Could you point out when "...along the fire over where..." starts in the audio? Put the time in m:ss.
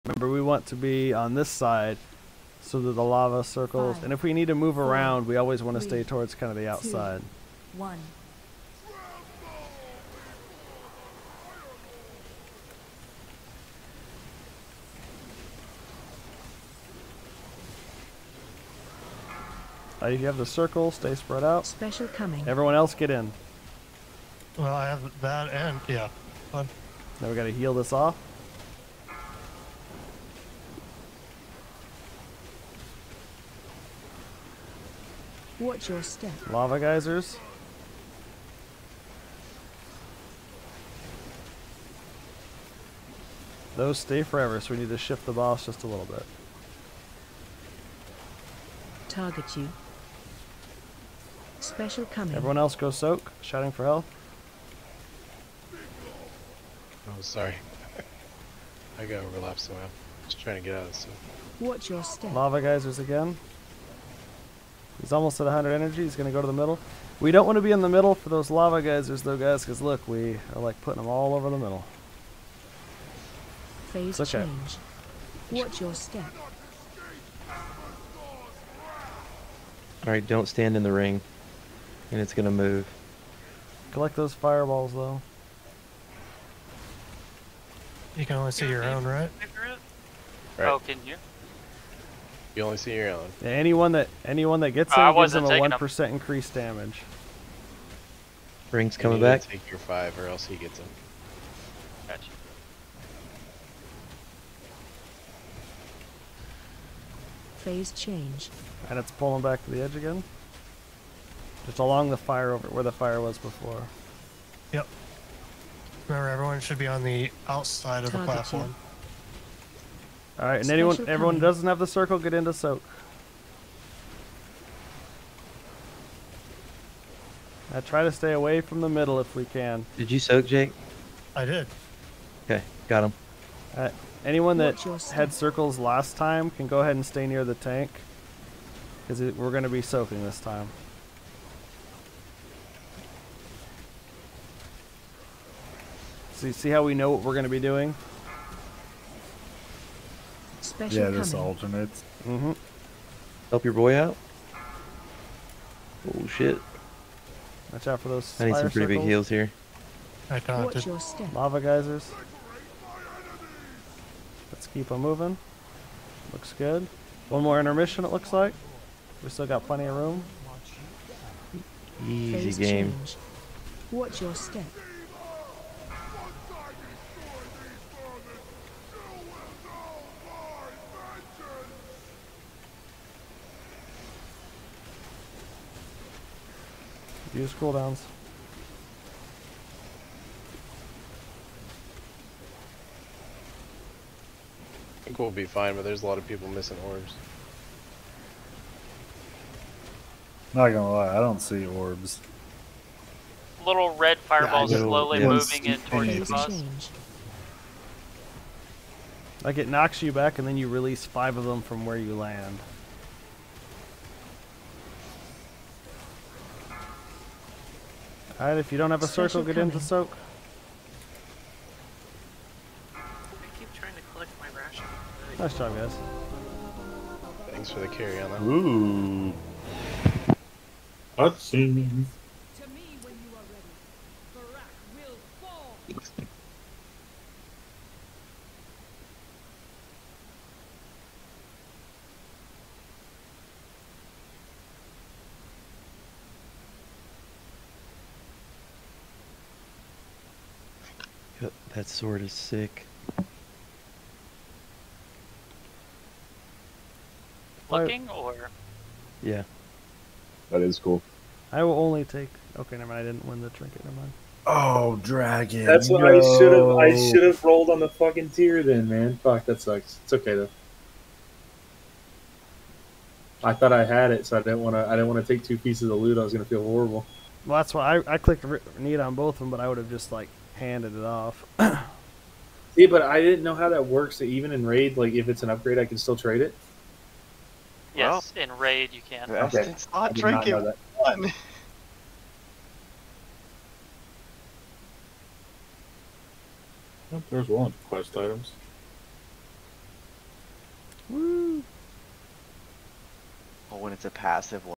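1:51.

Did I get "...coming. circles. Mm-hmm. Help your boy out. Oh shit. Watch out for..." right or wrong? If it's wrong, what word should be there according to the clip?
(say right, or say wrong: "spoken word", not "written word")
wrong: "alternates", not "circles".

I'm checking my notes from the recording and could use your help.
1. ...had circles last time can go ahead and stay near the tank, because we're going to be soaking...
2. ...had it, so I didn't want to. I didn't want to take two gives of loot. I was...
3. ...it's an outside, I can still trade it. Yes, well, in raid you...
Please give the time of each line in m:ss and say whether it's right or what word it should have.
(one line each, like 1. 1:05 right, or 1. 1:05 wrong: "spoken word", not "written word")
1. 2:15 right
2. 4:33 wrong: "pieces", not "gives"
3. 4:45 wrong: "upgrade", not "outside".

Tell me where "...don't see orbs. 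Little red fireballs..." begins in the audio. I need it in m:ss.
3:21.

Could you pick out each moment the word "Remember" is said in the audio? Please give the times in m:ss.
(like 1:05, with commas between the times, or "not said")
0:00, 1:56.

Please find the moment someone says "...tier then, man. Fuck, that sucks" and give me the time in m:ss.
4:28.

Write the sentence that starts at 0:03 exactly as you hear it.
Five, and if we need to move four, around, we always want to stay towards kind of the outside.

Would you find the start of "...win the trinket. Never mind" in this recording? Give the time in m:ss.
4:23.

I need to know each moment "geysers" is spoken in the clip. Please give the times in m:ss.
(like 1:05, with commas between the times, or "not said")
0:36, 1:02, 1:08, 2:41.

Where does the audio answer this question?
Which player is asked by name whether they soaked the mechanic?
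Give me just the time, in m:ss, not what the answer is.
2:10.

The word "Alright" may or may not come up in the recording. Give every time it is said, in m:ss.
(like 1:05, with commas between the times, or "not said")
1:20, 3:38.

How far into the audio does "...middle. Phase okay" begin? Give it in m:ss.
1:11.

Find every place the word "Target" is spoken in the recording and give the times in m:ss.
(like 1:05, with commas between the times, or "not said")
0:49, 1:58.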